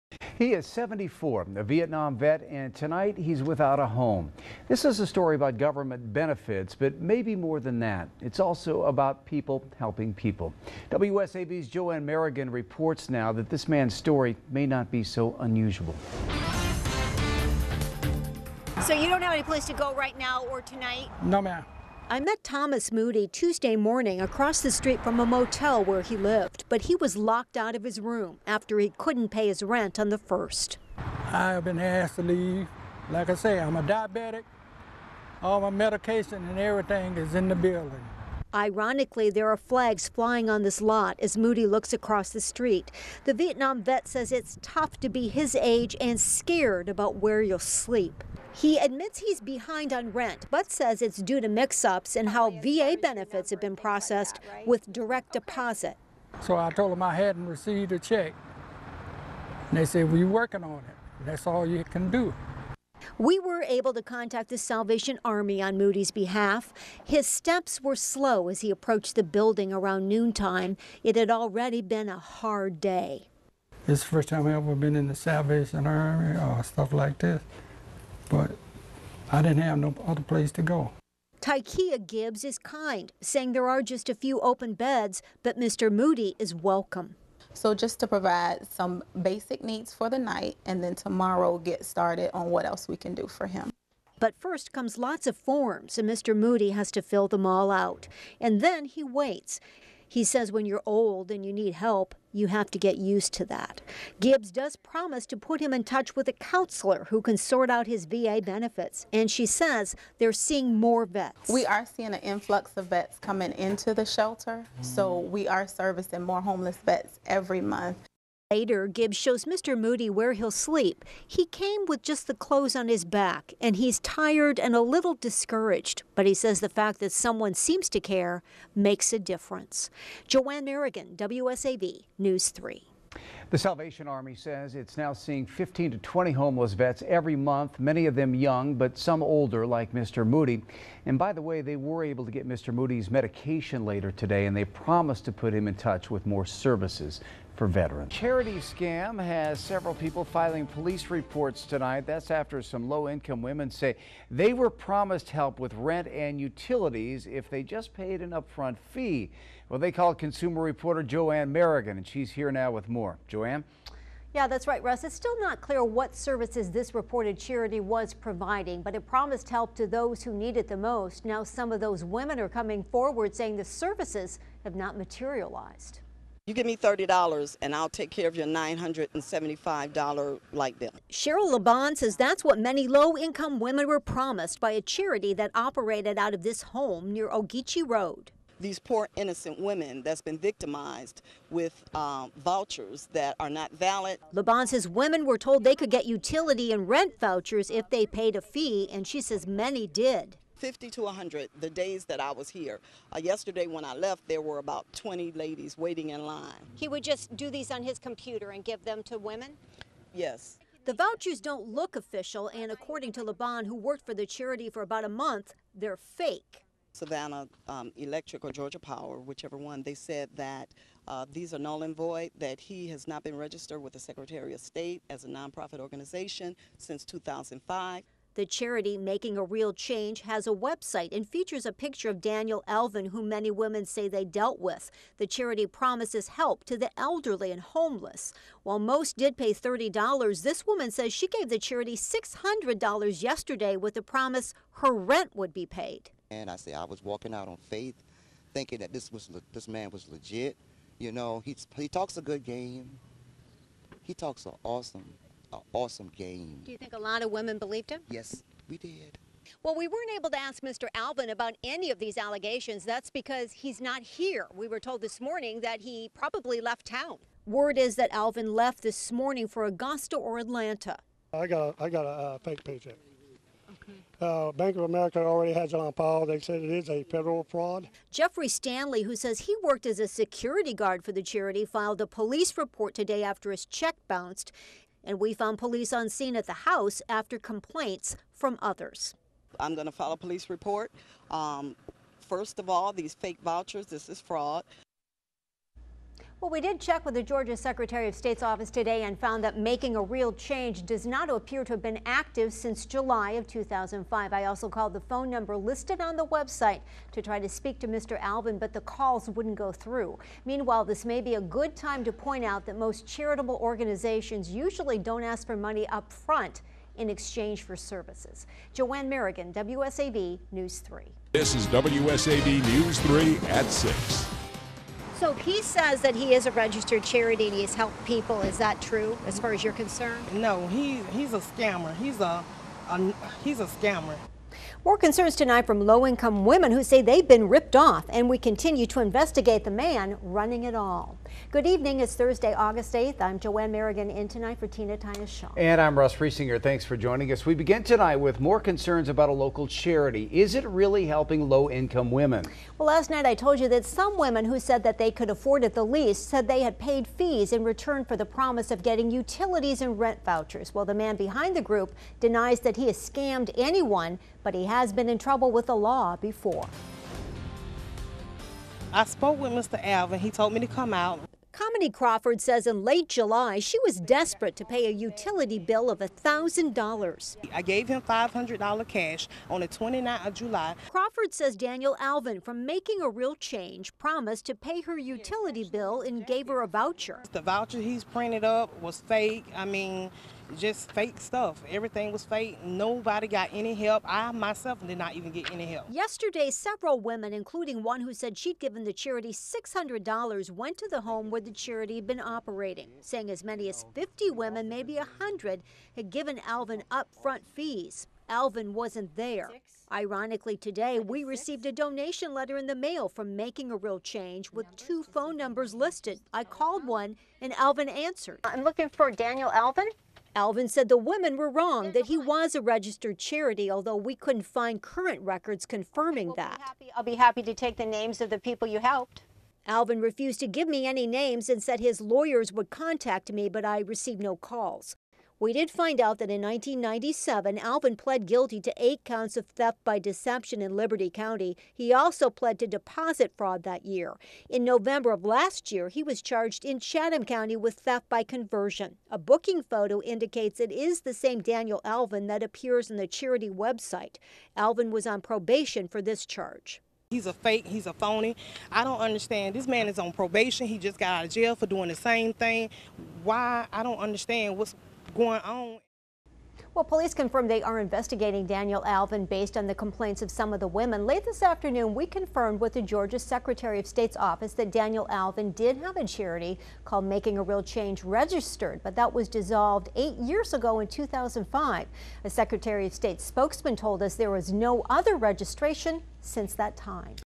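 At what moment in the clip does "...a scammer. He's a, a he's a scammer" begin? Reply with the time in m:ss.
5:31.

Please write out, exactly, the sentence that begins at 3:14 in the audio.
Laban says women were told they could get utility and rent vouchers if they paid a fee, and she says many did.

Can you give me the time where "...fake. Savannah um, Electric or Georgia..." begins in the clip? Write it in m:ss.
3:35.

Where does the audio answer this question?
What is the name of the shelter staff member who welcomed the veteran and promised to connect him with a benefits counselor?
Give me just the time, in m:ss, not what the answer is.
1:21.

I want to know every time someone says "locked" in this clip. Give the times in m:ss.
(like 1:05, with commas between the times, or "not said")
0:27.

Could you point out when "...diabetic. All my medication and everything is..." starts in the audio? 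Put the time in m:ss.
0:33.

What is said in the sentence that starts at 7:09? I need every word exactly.
Alvin refused to give me any names and said his lawyers would contact me, but I received no calls.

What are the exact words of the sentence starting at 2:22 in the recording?
Moody's medication later today, and they promised to put him in touch with more services for veterans.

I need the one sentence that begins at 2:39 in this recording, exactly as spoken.
Well, they called consumer reporter JoAnn Merrigan, and she's here now with more.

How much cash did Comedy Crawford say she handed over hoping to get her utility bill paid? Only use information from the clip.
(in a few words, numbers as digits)
$500.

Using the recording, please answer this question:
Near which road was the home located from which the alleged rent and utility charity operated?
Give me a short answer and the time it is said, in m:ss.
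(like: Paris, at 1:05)
Ogeechee Road, at 3:07.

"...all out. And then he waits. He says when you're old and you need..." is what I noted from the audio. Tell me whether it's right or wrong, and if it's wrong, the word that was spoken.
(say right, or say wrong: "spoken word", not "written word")
right.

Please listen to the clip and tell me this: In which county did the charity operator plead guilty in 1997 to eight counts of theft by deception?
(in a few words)
Liberty County.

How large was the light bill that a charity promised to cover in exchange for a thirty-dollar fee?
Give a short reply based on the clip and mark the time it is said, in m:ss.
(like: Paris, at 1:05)
$975, at 2:58.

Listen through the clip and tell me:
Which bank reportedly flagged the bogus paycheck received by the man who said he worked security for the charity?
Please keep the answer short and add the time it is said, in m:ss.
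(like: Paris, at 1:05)
Bank of America, at 4:34.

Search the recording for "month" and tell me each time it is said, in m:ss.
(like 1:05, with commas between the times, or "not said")
1:57, 2:17, 3:35.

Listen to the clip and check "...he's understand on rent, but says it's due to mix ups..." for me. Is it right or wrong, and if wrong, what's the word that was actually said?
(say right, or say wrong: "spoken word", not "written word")
wrong: "behind", not "understand".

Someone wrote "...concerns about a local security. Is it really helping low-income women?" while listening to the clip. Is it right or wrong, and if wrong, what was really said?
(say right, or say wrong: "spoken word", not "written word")
wrong: "charity", not "security".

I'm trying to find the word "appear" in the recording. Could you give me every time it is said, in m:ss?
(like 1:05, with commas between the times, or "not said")
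5:01, 7:32.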